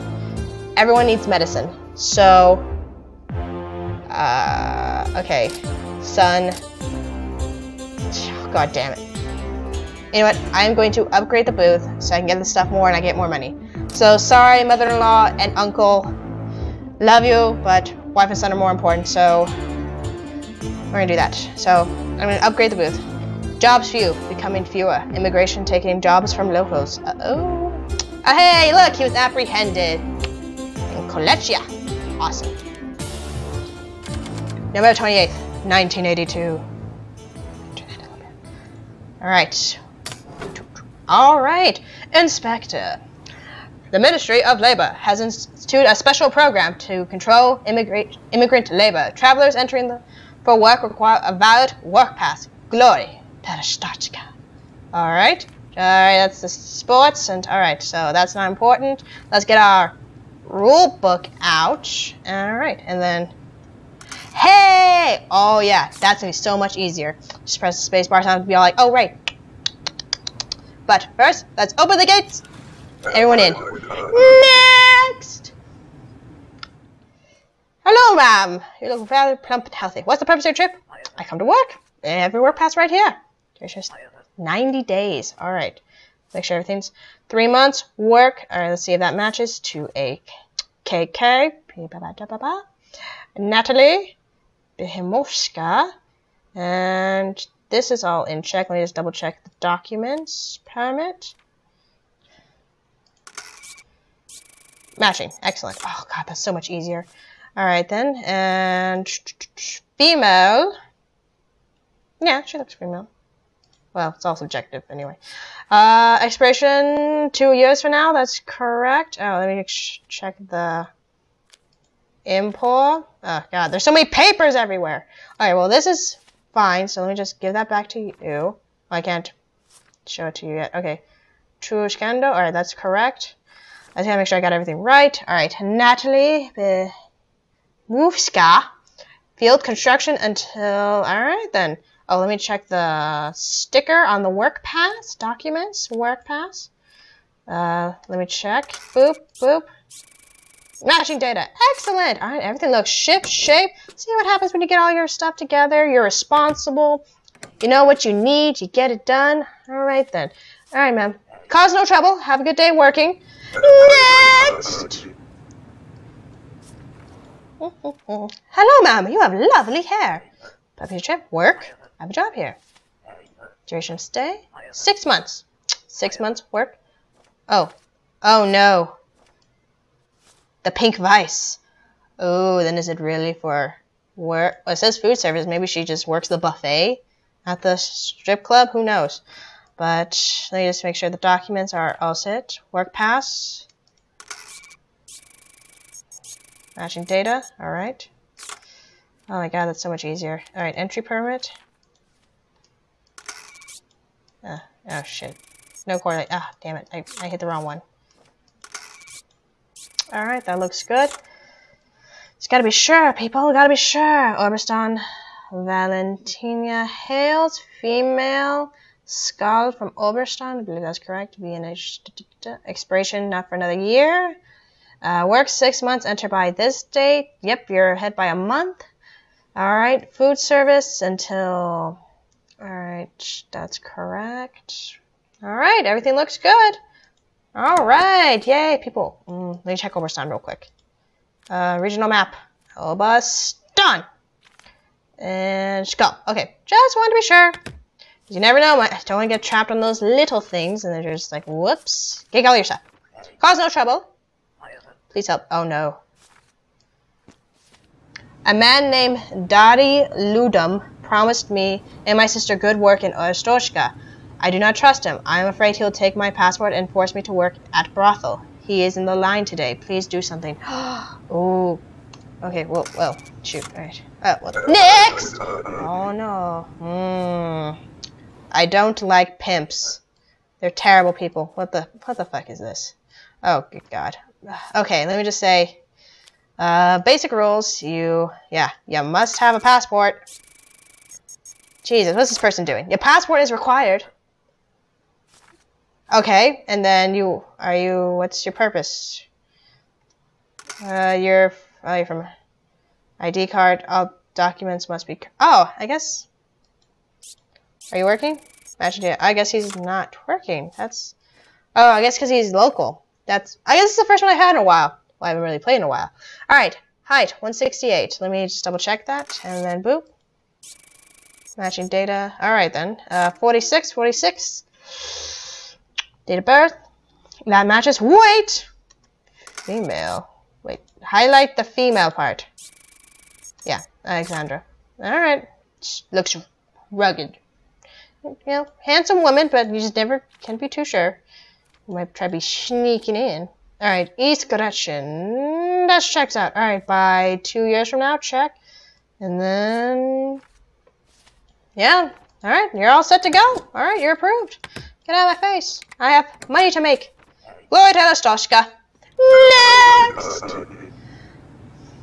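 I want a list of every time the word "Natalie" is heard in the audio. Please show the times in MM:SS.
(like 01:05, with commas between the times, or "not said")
01:33, 02:15.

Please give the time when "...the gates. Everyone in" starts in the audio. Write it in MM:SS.
01:11.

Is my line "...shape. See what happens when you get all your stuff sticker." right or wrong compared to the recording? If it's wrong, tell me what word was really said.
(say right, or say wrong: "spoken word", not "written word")
wrong: "together", not "sticker".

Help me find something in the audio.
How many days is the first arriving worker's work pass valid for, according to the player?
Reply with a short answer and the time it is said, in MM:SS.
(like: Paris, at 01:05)
90, at 01:24.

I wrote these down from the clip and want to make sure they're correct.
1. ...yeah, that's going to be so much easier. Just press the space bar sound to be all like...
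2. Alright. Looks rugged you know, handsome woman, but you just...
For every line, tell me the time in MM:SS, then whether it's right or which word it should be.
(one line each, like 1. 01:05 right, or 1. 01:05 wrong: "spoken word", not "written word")
1. 01:05 right
2. 05:35 right.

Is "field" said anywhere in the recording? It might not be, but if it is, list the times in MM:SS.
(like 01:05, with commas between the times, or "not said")
02:19.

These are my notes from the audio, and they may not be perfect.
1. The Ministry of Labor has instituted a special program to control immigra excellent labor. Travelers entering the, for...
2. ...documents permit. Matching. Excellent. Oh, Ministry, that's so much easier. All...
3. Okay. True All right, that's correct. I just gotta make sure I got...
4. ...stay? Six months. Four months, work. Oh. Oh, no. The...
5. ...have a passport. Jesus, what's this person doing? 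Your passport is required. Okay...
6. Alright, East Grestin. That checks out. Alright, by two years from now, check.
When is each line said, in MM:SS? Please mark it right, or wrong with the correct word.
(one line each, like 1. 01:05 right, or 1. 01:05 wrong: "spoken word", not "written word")
1. 00:43 wrong: "immigrant", not "excellent"
2. 01:39 wrong: "God", not "Ministry"
3. 02:10 right
4. 02:54 wrong: "Six", not "Four"
5. 04:49 right
6. 05:43 right.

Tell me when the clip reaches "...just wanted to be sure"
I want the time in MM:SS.
04:06.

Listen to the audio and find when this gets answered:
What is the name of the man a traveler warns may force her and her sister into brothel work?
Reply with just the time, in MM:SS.
04:19.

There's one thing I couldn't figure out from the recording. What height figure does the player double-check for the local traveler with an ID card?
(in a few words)
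168.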